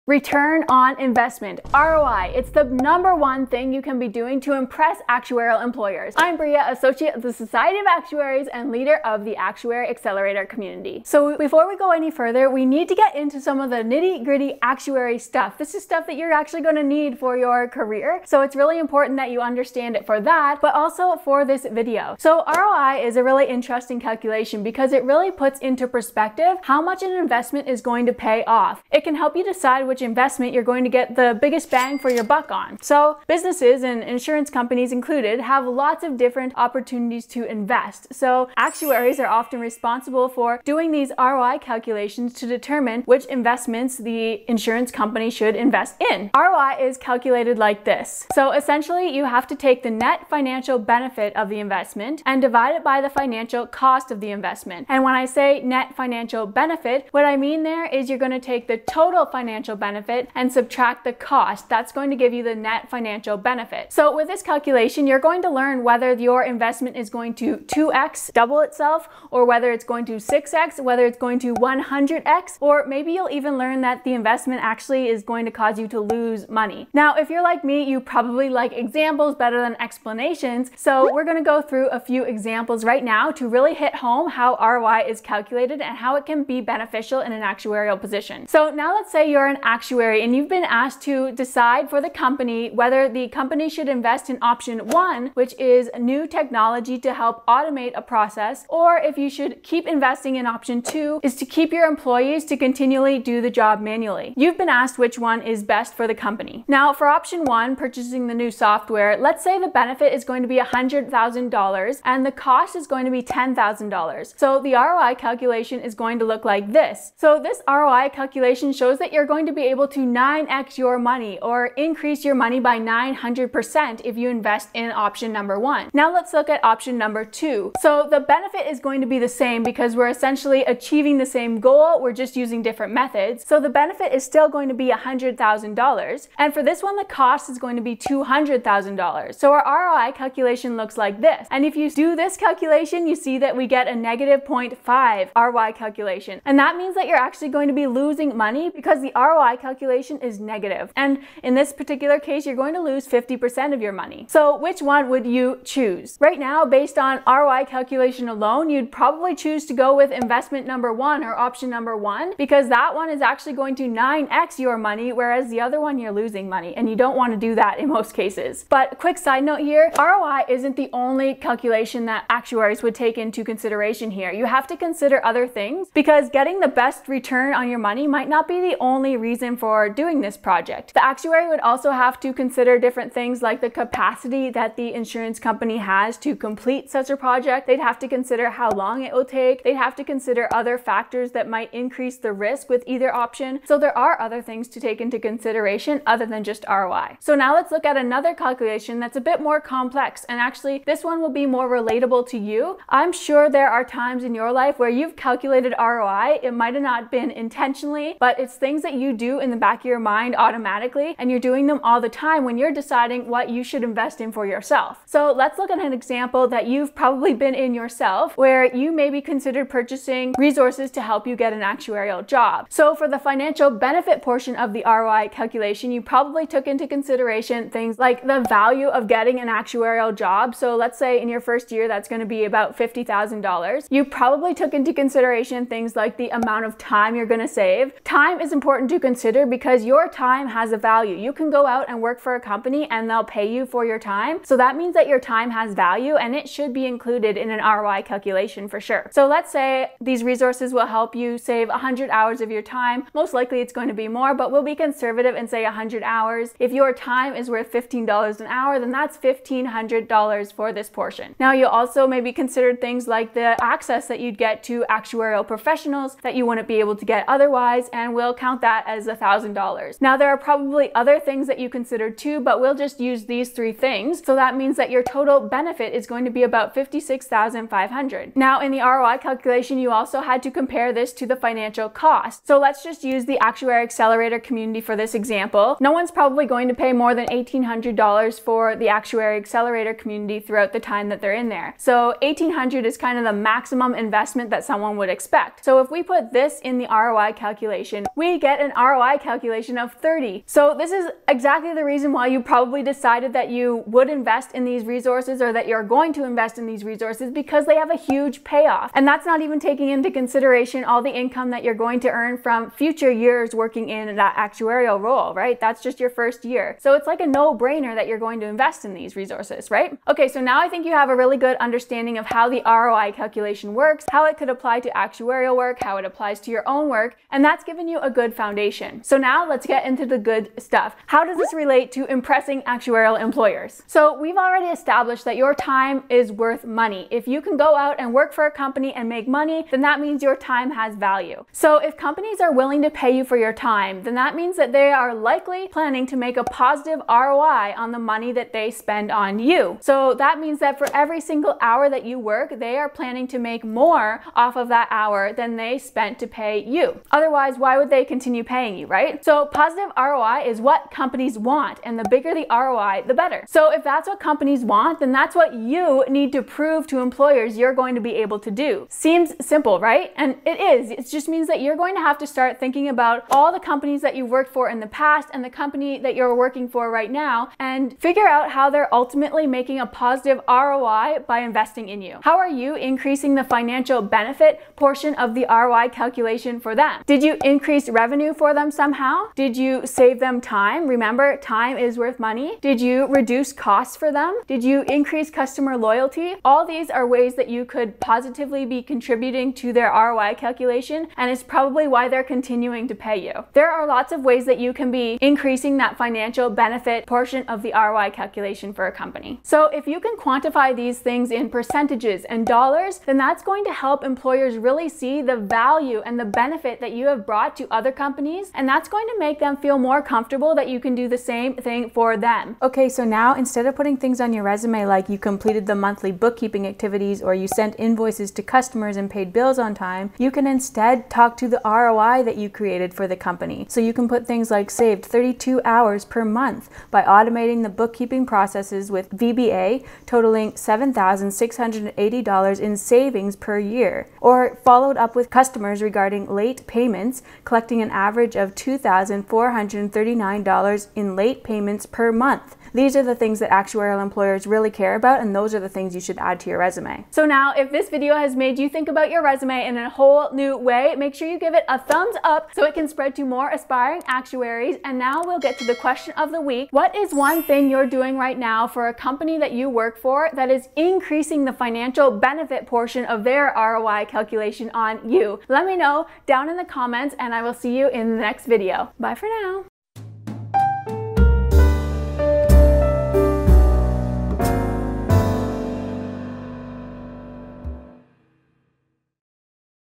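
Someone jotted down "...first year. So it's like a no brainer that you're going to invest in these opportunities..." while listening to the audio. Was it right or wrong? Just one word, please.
wrong.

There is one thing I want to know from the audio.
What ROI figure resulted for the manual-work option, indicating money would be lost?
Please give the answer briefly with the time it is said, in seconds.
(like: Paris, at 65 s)
-0.5, at 143 s.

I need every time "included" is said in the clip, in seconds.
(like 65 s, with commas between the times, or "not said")
34 s, 246 s.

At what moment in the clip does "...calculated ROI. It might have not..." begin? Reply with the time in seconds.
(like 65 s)
205 s.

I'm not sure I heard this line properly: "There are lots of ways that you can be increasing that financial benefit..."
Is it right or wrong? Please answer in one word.
right.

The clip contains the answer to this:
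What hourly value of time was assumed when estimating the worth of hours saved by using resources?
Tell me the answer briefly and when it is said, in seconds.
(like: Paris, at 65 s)
$15, at 257 s.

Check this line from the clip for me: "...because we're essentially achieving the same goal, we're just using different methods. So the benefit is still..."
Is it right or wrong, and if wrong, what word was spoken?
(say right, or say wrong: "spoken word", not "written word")
right.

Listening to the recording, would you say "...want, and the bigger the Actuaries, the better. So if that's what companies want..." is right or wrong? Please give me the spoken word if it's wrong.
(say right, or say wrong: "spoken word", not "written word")
wrong: "ROI", not "Actuaries".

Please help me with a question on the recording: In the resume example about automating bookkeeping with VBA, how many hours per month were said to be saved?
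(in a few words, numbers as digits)
32 hours.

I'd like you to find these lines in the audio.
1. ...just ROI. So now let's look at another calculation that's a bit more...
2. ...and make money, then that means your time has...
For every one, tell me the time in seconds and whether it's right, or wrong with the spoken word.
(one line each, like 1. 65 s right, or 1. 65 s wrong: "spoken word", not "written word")
1. 196 s right
2. 338 s right.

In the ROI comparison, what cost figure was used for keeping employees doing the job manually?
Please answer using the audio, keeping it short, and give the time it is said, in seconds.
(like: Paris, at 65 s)
$200,000, at 137 s.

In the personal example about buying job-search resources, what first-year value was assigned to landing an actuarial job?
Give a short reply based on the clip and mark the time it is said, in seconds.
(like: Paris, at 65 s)
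$50,000, at 232 s.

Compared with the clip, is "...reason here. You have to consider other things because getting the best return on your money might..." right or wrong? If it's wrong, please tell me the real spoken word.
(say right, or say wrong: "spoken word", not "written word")
wrong: "consideration", not "reason".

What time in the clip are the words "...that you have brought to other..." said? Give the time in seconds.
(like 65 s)
416 s.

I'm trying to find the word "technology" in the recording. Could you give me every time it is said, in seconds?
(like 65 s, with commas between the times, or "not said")
96 s.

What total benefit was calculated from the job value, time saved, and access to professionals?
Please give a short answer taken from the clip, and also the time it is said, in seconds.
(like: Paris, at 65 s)
$56,500, at 276 s.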